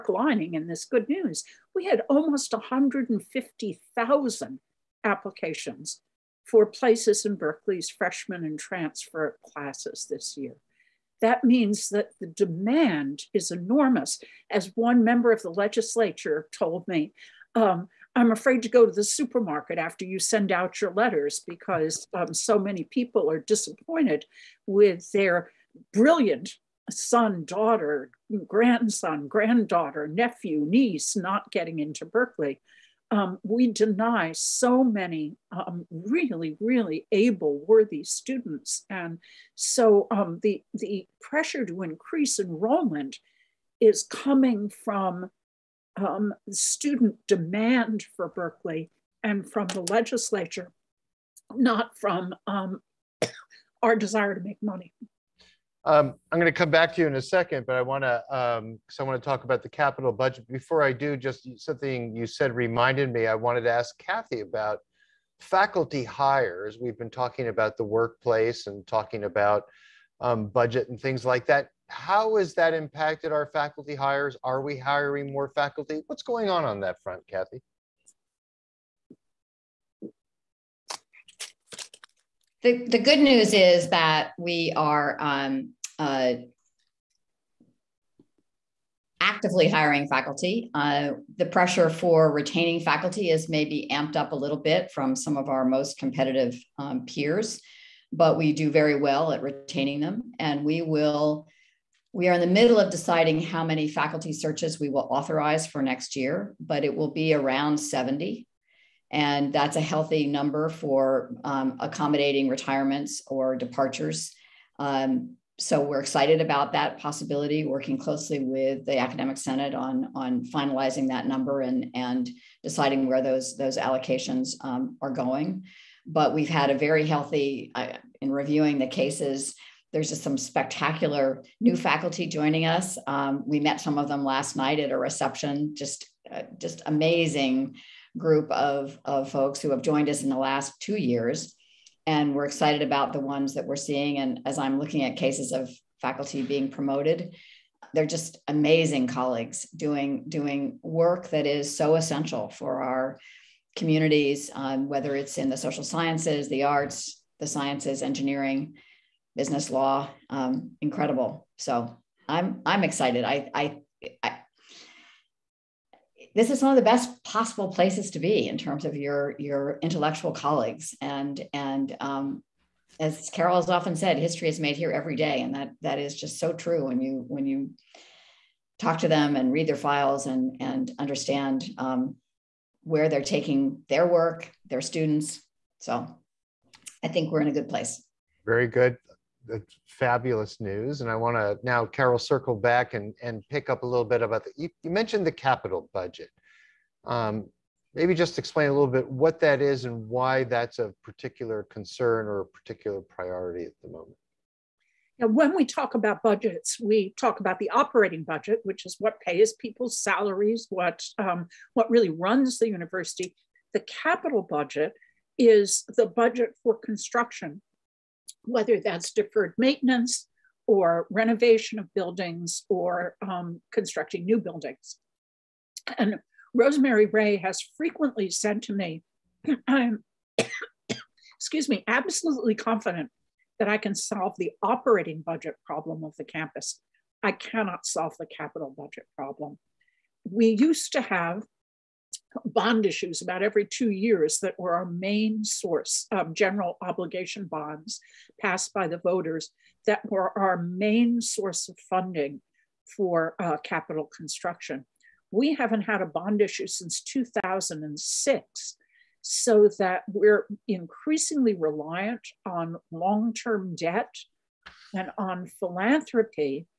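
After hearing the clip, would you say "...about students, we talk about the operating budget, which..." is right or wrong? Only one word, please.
wrong.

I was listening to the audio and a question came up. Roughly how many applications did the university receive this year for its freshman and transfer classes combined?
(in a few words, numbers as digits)
150,000.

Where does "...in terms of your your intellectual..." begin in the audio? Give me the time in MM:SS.
02:48.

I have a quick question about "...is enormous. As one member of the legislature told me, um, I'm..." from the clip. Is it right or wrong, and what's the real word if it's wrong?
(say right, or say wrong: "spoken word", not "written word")
right.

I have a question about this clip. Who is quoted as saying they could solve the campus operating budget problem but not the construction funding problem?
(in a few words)
Rosemary Ray.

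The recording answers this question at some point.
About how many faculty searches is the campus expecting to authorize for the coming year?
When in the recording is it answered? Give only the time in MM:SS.
01:47.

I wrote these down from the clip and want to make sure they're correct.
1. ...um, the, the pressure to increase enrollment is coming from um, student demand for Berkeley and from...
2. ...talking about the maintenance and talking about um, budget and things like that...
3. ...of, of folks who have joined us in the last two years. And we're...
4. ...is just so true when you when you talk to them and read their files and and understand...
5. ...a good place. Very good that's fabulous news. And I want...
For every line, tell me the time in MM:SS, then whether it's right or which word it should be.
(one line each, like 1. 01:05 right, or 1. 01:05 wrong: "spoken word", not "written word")
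1. 00:40 right
2. 01:07 wrong: "workplace", not "maintenance"
3. 02:18 right
4. 02:55 right
5. 03:07 right.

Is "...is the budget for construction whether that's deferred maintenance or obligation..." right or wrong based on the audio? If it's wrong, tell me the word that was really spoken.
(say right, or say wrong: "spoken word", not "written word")
wrong: "renovation", not "obligation".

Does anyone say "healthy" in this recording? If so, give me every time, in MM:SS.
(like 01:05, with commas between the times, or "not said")
01:49, 02:07.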